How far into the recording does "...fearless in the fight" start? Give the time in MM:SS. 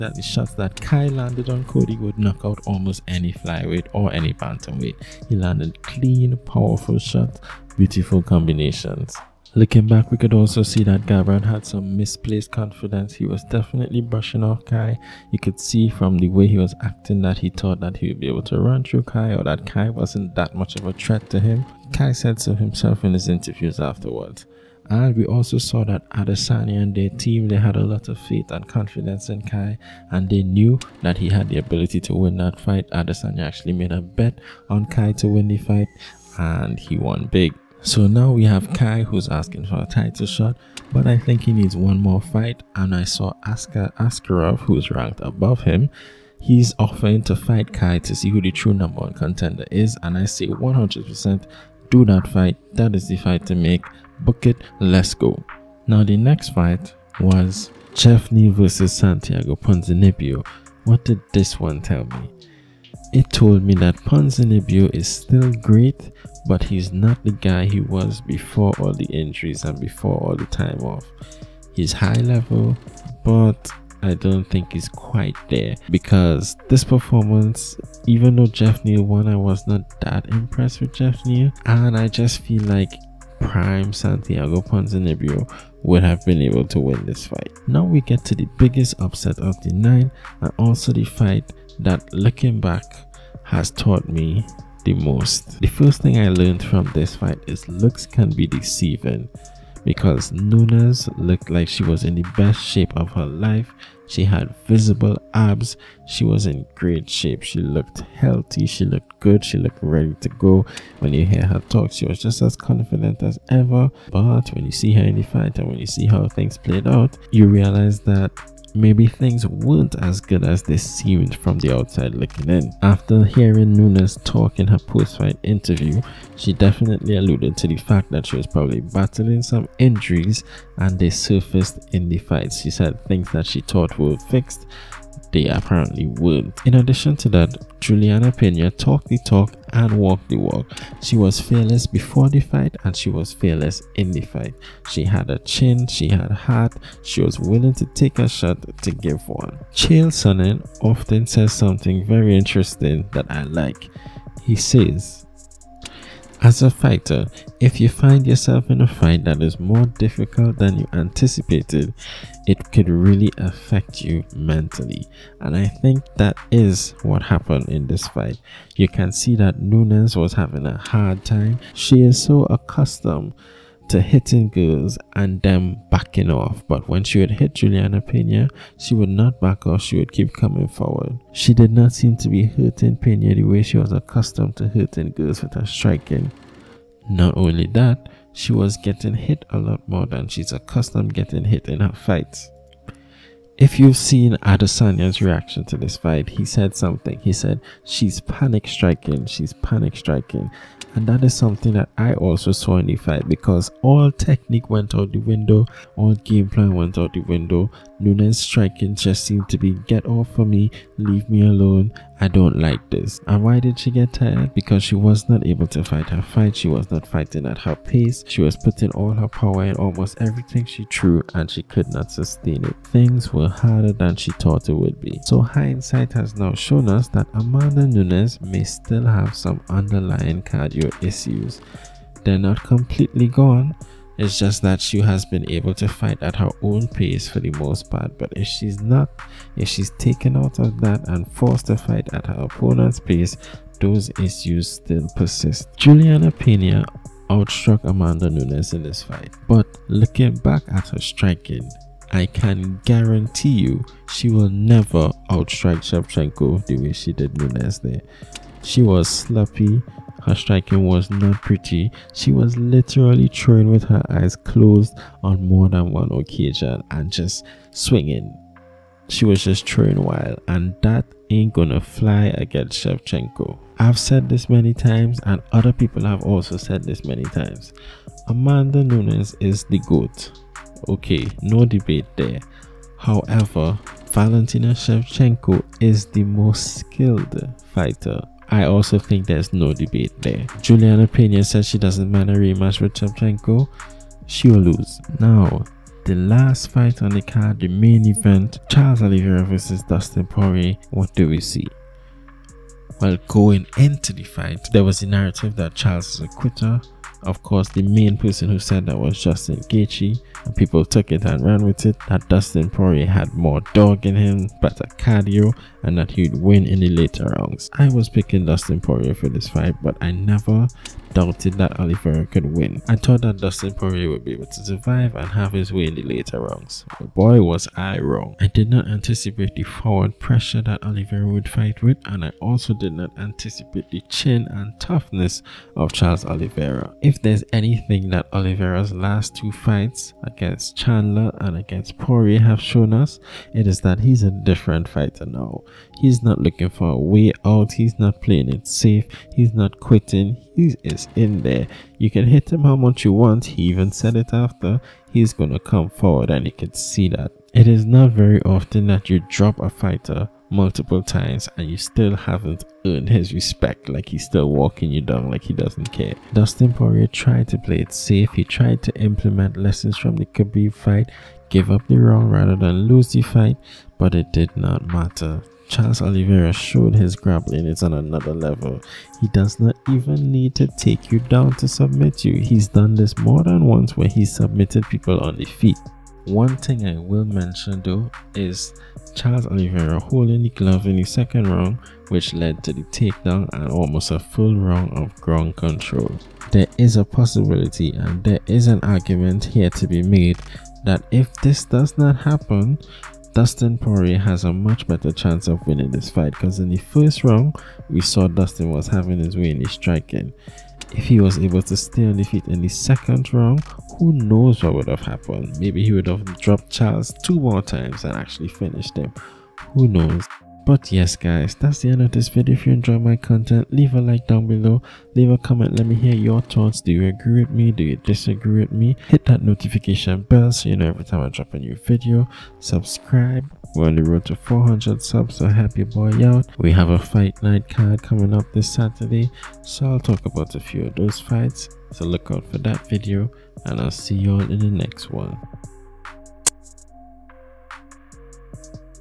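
02:23.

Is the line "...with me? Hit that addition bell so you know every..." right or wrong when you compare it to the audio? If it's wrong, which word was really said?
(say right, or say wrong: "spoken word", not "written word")
wrong: "notification", not "addition".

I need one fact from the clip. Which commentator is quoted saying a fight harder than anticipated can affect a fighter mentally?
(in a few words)
Chael Sonnen.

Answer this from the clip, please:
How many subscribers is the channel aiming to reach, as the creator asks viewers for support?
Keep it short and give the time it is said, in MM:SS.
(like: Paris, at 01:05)
400, at 07:14.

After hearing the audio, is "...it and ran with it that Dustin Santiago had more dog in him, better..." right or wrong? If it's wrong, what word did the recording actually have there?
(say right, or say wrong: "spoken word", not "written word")
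wrong: "Poirier", not "Santiago".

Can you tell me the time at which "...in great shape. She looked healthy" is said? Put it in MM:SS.
01:46.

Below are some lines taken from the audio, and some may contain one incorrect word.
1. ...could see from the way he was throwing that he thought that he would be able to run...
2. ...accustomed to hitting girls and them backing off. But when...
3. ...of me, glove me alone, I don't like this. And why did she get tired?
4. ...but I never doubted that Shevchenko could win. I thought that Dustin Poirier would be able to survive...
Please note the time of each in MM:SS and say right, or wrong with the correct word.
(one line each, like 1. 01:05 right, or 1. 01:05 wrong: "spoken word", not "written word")
1. 00:15 wrong: "acting", not "throwing"
2. 02:52 right
3. 03:30 wrong: "leave", not "glove"
4. 05:19 wrong: "Oliveira", not "Shevchenko".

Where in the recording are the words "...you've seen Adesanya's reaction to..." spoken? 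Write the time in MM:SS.
03:13.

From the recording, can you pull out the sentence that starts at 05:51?
You can hit him how much you want, he even said it after, he's gonna come forward and you can see that.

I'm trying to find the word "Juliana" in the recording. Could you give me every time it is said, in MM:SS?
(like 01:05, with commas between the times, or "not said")
02:17, 02:57, 04:05, 04:50.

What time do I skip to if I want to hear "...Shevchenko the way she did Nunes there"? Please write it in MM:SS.
04:15.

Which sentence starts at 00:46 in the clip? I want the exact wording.
He's offering to fight Kai to see who the true number one contender is.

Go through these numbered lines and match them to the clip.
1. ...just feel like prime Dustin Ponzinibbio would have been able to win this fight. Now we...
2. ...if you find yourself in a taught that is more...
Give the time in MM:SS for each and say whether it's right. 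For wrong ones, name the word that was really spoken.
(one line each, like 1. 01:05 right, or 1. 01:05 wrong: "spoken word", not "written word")
1. 01:22 wrong: "Santiago", not "Dustin"
2. 02:37 wrong: "fight", not "taught".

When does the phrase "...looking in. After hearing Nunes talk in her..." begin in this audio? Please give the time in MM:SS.
02:02.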